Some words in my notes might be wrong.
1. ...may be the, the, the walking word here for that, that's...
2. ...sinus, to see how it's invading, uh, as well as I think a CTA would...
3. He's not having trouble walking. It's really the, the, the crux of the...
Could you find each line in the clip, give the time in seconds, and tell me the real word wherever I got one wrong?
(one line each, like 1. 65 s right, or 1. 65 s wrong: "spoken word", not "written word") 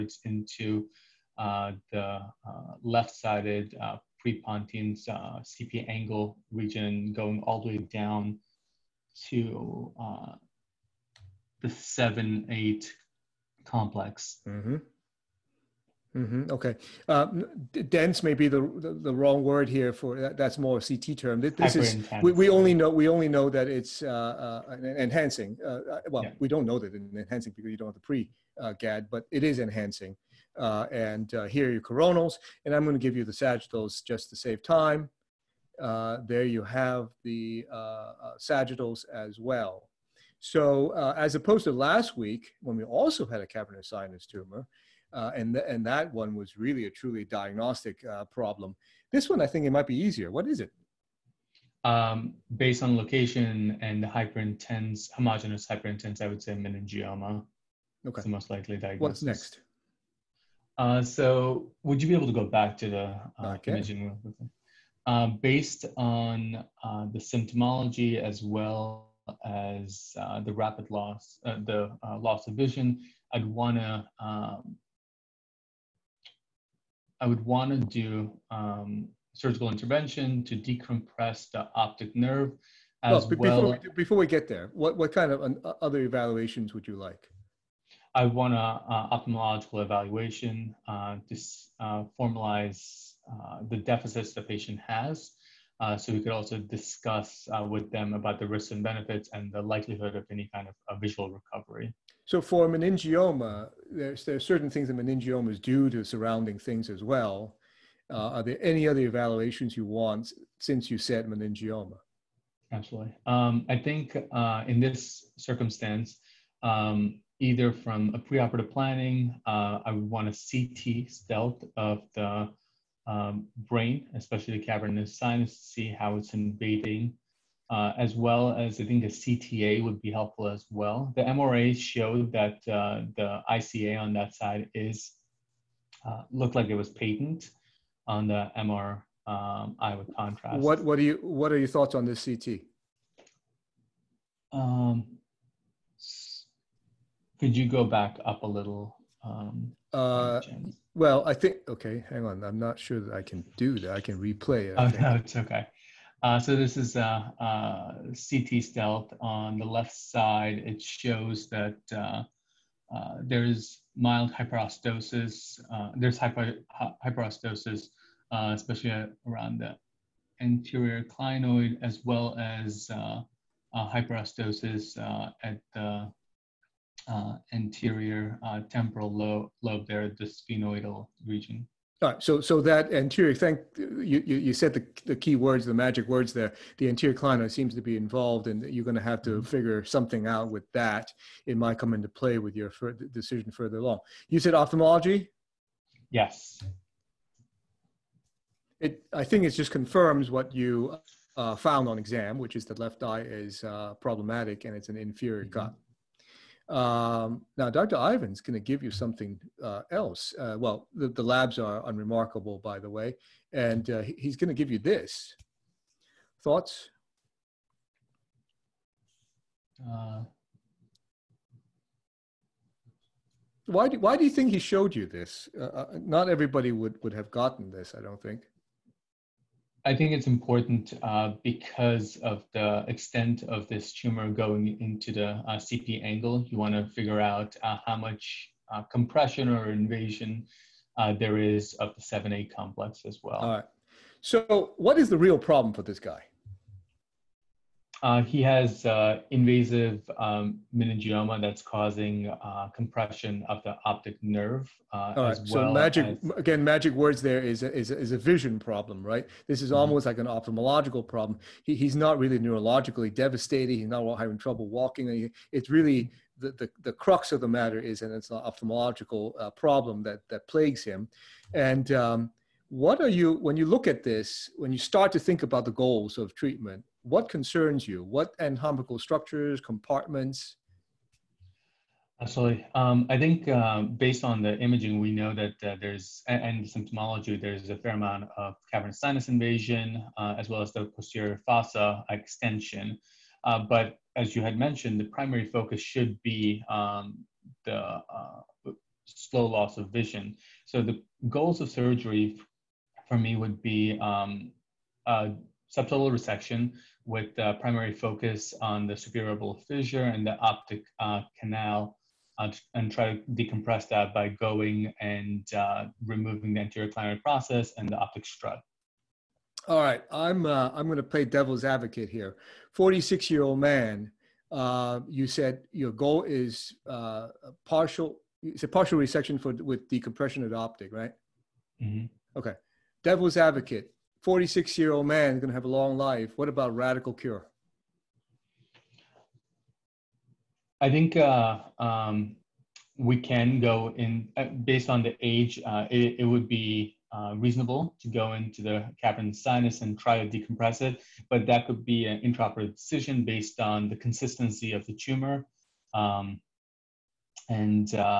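1. 18 s wrong: "wrong", not "walking"
2. 125 s right
3. 263 s right.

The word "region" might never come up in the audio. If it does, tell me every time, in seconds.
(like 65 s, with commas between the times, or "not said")
6 s, 181 s.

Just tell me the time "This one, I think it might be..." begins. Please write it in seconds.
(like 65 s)
49 s.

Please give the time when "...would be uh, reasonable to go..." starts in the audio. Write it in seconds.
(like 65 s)
346 s.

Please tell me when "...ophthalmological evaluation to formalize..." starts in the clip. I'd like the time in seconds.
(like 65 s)
89 s.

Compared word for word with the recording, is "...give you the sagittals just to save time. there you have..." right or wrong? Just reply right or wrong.
right.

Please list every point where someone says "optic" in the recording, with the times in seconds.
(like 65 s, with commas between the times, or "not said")
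81 s, 253 s, 310 s, 317 s, 330 s.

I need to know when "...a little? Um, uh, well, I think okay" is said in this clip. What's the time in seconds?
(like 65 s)
148 s.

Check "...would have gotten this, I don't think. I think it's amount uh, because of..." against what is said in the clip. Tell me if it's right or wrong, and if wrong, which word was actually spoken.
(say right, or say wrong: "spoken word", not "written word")
wrong: "important", not "amount".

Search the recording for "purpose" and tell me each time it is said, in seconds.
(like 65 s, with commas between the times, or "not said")
not said.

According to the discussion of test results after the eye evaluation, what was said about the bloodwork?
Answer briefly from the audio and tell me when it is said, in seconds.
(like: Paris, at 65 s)
unremarkable, at 211 s.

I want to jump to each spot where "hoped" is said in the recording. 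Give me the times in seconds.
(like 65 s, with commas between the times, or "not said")
not said.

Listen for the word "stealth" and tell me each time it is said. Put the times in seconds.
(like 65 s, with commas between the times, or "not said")
121 s, 158 s.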